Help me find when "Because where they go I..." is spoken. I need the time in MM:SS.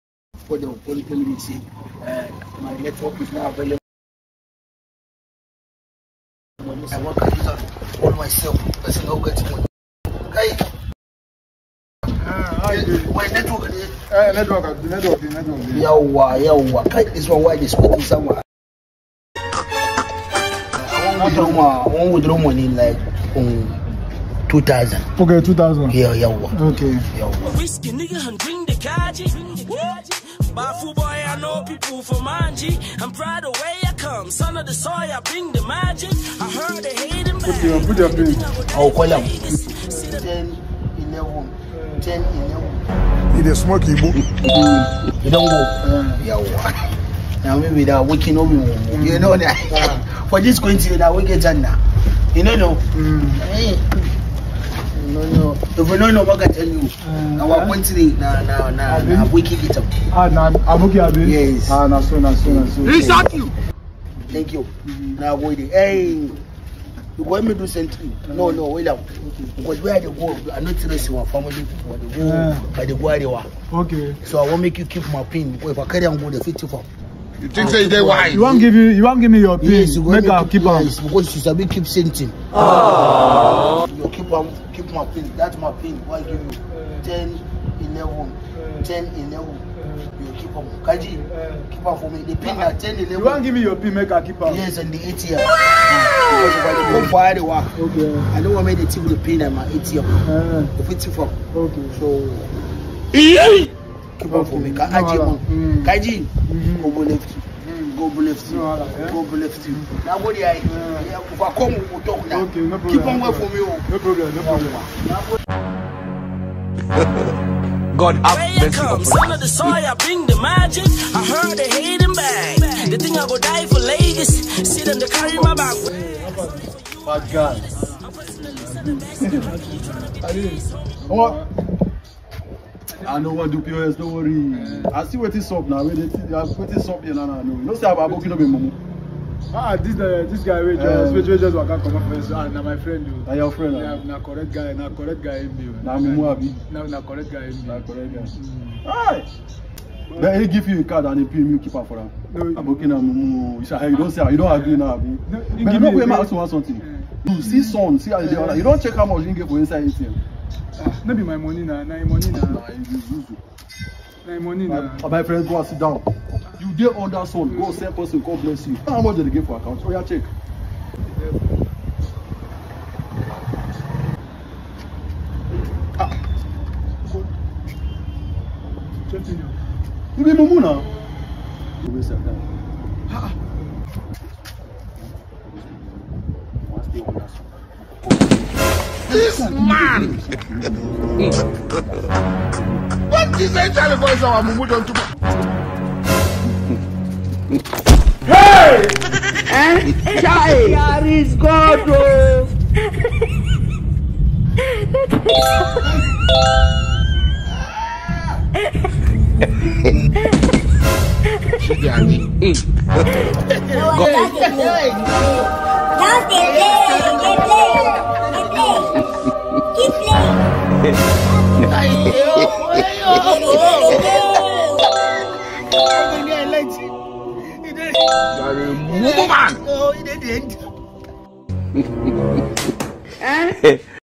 01:09.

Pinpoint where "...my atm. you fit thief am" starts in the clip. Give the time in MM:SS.
01:39.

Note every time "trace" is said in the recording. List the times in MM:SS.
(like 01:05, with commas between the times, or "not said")
01:10.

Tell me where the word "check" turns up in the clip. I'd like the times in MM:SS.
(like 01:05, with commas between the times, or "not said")
02:38, 02:50.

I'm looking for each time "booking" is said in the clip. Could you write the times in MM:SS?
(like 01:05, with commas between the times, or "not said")
02:18.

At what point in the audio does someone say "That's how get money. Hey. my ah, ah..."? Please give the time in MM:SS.
00:08.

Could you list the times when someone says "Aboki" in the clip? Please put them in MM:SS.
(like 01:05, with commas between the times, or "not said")
02:32.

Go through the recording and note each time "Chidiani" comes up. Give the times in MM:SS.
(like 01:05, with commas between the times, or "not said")
03:31.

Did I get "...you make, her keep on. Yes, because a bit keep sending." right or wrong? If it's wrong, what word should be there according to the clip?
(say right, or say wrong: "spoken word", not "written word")
right.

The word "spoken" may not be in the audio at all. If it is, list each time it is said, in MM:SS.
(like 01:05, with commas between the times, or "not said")
00:17.